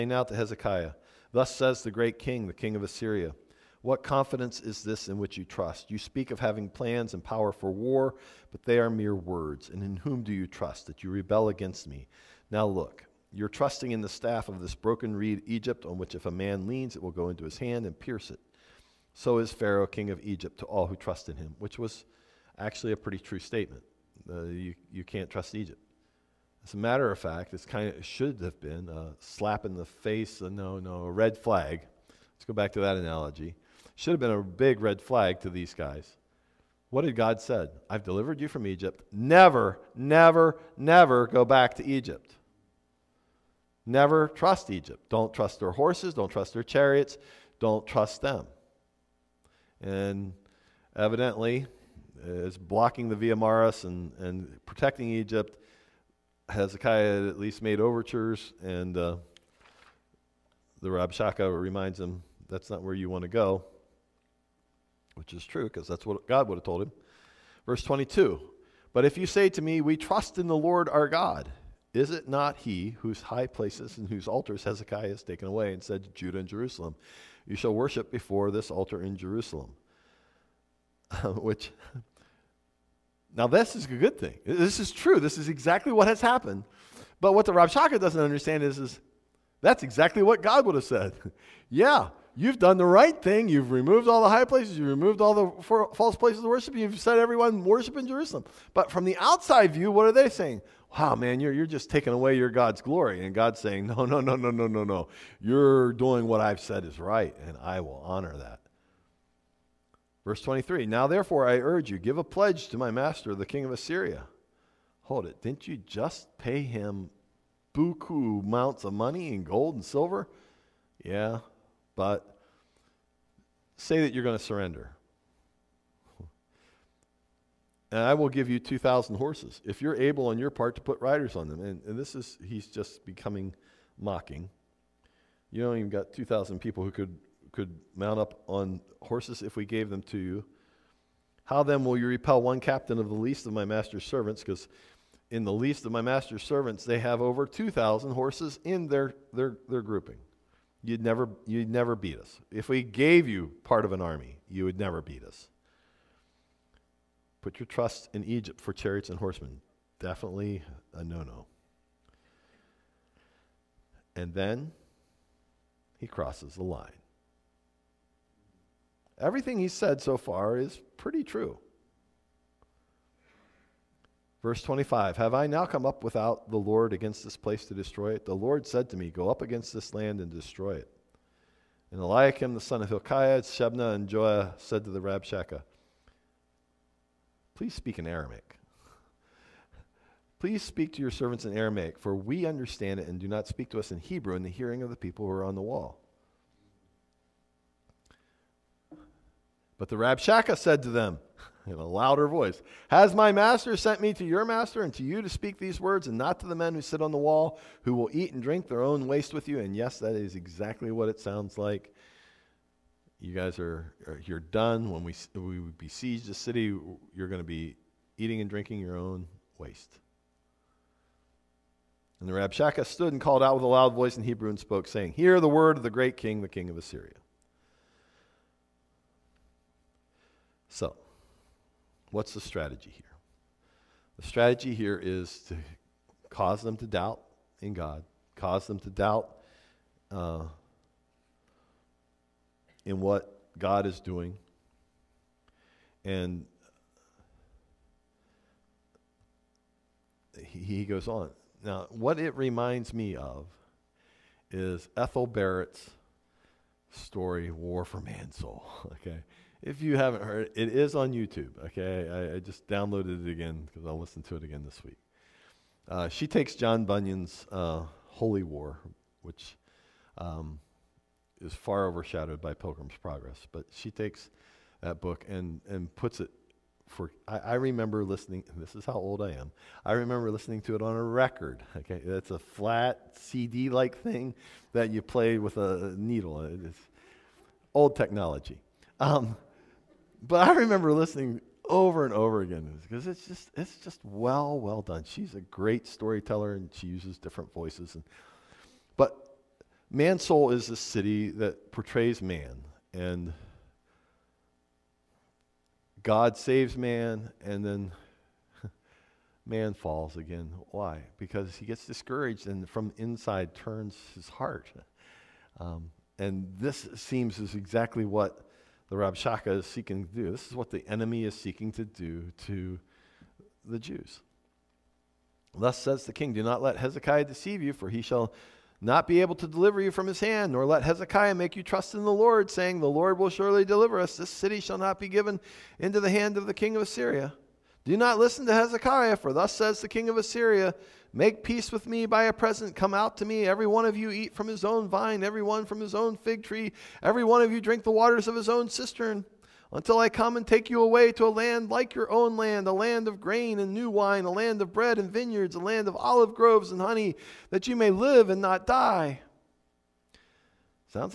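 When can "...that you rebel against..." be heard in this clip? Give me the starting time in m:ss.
0:10.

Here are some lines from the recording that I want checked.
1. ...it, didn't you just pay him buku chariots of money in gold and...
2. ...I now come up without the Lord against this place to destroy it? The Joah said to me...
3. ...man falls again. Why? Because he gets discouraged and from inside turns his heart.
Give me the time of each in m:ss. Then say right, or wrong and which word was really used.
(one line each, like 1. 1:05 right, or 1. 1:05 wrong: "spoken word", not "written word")
1. 1:55 wrong: "amounts", not "chariots"
2. 2:55 wrong: "Lord", not "Joah"
3. 5:09 right.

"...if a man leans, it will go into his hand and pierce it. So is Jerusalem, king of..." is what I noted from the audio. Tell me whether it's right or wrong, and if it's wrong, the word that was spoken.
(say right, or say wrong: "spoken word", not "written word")
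wrong: "Pharaoh", not "Jerusalem".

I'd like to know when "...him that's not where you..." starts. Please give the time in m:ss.
1:01.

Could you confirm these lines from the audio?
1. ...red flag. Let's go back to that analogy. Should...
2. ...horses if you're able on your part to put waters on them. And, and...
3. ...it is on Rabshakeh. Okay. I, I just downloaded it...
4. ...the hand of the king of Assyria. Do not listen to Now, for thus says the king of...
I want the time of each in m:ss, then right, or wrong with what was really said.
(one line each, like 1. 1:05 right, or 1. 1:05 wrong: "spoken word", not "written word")
1. 0:31 right
2. 2:09 wrong: "riders", not "waters"
3. 4:20 wrong: "YouTube", not "Rabshakeh"
4. 5:35 wrong: "Hezekiah", not "Now".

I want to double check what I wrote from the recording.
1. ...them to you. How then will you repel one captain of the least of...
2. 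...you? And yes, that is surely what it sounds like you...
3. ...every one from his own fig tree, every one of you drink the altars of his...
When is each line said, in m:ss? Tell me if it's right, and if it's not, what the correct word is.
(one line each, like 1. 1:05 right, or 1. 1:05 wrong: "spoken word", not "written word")
1. 2:19 right
2. 3:29 wrong: "exactly", not "surely"
3. 5:45 wrong: "waters", not "altars".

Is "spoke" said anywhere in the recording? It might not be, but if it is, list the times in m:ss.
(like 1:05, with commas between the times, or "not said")
3:44.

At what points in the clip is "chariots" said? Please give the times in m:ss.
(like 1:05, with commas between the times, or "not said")
0:46, 2:38.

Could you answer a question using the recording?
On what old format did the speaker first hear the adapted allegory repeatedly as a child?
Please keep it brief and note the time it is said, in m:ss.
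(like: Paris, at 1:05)
a record, at 4:40.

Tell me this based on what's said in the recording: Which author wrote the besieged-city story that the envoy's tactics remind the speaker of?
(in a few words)
Ethel Barrett.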